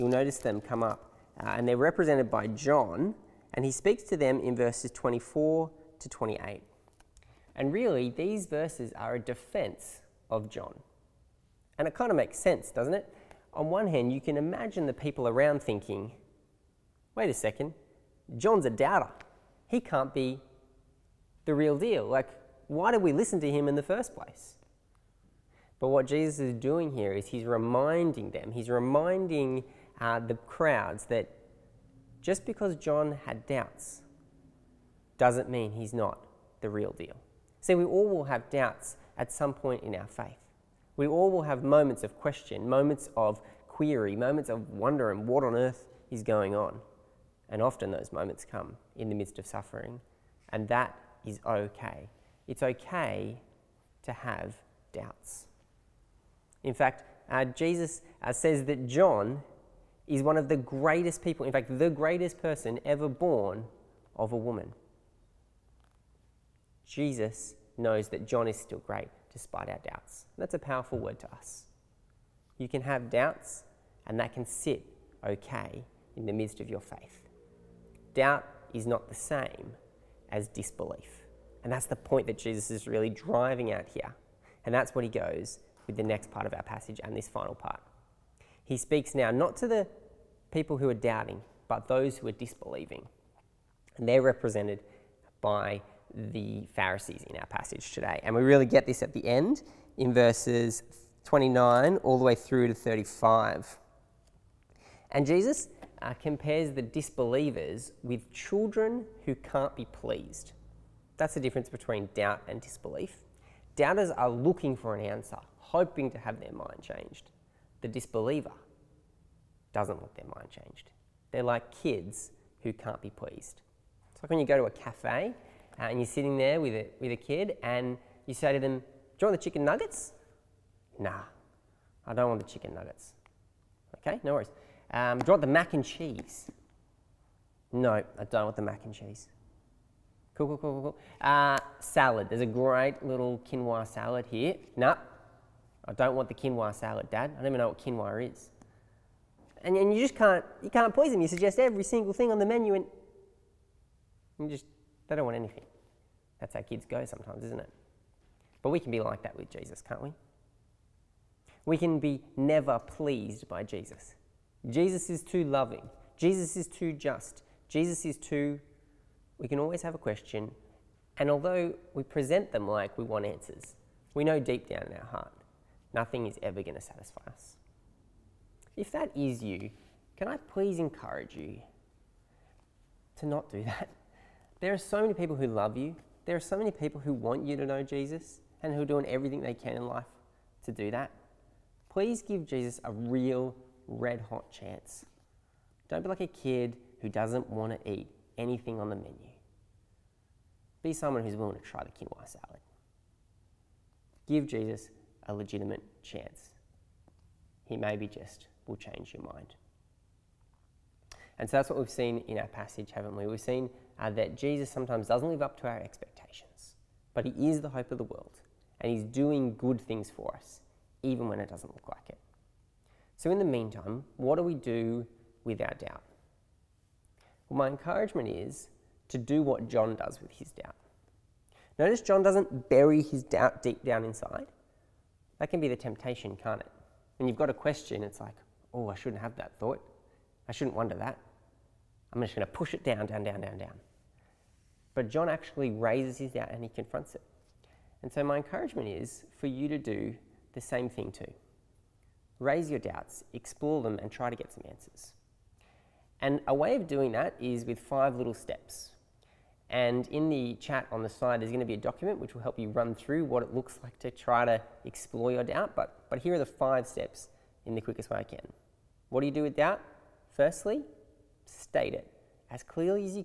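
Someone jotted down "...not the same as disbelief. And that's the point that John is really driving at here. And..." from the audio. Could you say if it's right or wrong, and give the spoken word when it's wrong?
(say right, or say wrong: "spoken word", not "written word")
wrong: "Jesus", not "John".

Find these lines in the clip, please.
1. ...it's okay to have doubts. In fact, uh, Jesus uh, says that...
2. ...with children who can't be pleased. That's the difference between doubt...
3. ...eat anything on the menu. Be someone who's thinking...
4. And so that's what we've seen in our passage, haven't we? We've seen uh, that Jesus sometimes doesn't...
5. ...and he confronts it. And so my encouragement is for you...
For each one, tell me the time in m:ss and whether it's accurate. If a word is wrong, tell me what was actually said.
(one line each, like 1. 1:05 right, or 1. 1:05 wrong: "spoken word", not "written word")
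1. 0:52 right
2. 1:48 right
3. 3:17 wrong: "willing", not "thinking"
4. 3:31 right
5. 4:06 right.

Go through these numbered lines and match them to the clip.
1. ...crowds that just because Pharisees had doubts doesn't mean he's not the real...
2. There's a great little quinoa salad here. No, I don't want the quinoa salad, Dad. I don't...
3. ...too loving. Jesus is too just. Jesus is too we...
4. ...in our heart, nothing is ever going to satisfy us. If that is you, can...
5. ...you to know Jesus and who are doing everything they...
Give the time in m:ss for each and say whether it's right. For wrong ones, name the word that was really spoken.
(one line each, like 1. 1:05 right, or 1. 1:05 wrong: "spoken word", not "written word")
1. 0:30 wrong: "John", not "Pharisees"
2. 2:22 right
3. 2:45 right
4. 2:54 right
5. 3:07 right.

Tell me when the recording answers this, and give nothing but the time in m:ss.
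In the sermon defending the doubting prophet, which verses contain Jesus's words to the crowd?
0:04.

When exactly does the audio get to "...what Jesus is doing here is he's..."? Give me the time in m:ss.
0:25.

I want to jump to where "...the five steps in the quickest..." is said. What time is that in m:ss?
4:26.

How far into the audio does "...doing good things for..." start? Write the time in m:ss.
3:39.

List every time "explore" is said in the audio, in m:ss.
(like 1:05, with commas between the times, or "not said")
4:13, 4:24.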